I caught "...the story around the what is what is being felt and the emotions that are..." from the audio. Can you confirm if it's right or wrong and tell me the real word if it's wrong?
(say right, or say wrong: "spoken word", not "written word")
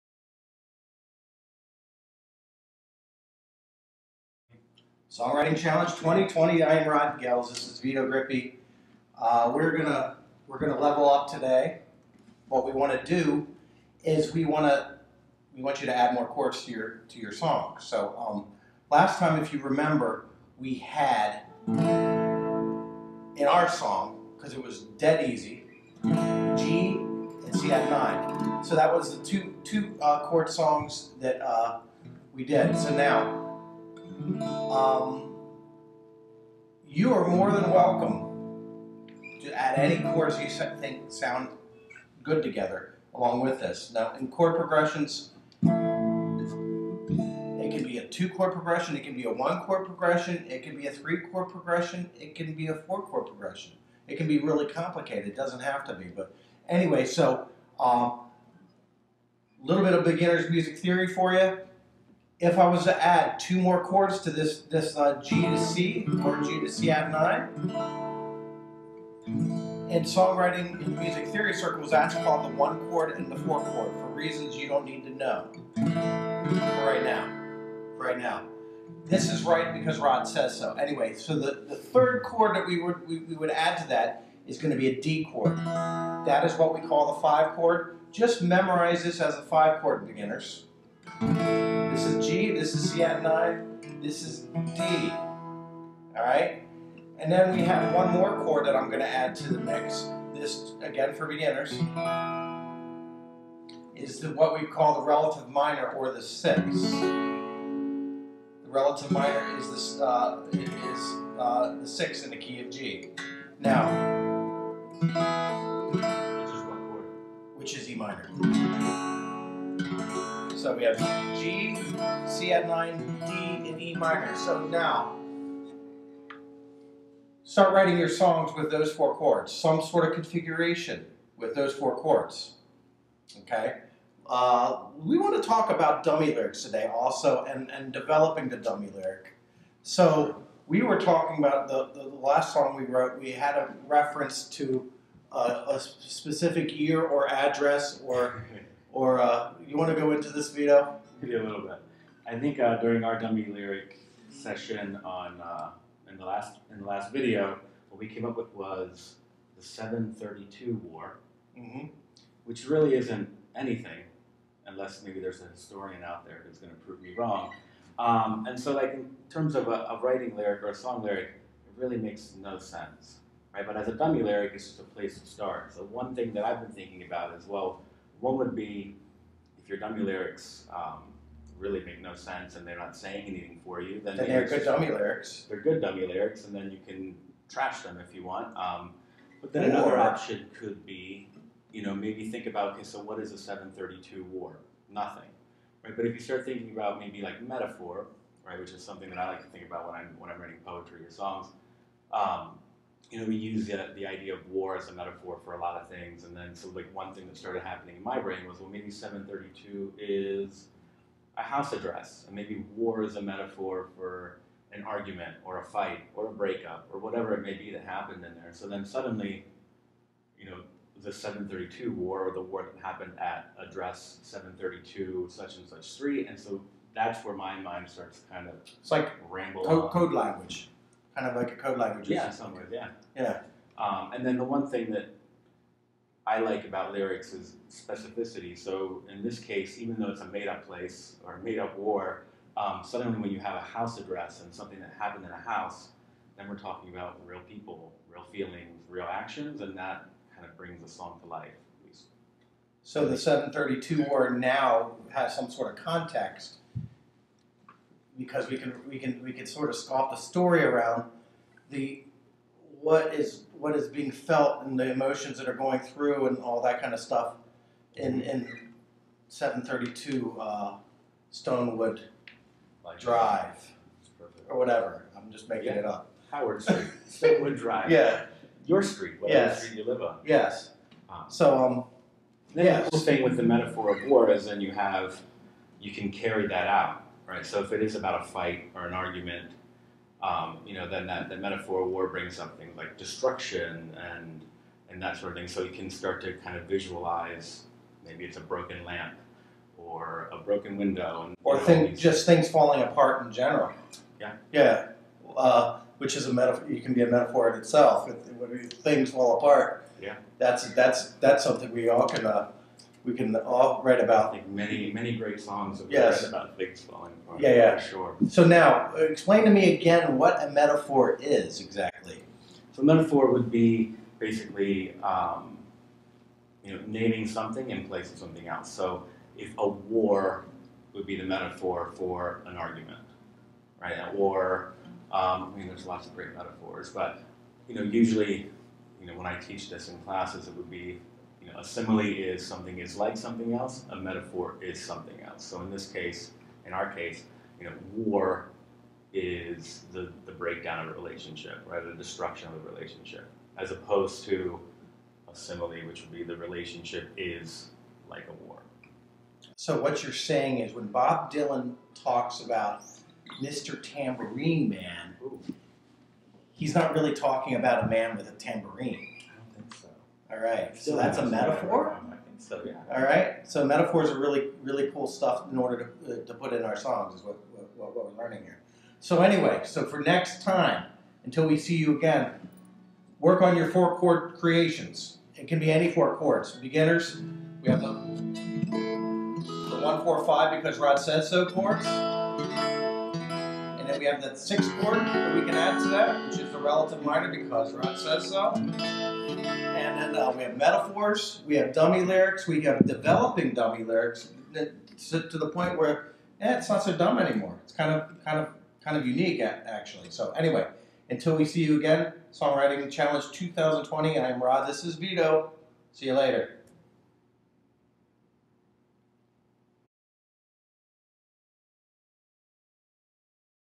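right.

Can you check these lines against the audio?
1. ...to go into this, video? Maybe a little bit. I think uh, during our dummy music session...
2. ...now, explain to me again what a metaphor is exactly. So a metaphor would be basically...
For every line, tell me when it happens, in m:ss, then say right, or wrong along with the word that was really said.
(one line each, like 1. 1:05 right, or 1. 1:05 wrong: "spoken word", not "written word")
1. 2:29 wrong: "lyric", not "music"
2. 5:18 right.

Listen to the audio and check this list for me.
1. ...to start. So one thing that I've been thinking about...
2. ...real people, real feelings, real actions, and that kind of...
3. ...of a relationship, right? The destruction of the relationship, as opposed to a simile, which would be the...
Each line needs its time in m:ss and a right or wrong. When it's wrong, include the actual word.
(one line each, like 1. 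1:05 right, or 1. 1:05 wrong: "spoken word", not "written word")
1. 2:55 right
2. 4:07 right
3. 5:50 right.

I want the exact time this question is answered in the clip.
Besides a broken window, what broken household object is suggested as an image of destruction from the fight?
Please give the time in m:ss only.
4:58.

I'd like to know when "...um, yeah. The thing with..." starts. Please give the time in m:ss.
4:41.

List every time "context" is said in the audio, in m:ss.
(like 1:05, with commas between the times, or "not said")
4:15.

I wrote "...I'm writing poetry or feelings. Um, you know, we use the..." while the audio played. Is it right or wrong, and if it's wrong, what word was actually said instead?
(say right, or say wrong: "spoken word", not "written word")
wrong: "songs", not "feelings".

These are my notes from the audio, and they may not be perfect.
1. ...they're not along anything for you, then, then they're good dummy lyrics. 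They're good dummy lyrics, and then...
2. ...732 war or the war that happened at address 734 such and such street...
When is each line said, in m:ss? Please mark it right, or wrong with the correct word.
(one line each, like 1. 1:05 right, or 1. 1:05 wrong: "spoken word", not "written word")
1. 3:02 wrong: "saying", not "along"
2. 3:41 wrong: "732", not "734".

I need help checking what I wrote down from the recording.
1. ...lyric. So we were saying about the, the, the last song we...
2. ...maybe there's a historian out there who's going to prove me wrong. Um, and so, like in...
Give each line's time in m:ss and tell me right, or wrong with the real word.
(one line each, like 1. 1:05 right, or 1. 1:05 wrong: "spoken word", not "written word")
1. 2:18 wrong: "talking", not "saying"
2. 2:45 right.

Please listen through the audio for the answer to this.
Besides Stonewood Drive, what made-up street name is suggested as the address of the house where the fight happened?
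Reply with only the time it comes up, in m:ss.
4:36.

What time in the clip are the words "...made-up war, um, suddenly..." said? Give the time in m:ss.
4:01.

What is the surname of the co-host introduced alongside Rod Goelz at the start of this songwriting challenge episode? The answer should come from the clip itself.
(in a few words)
Grippi.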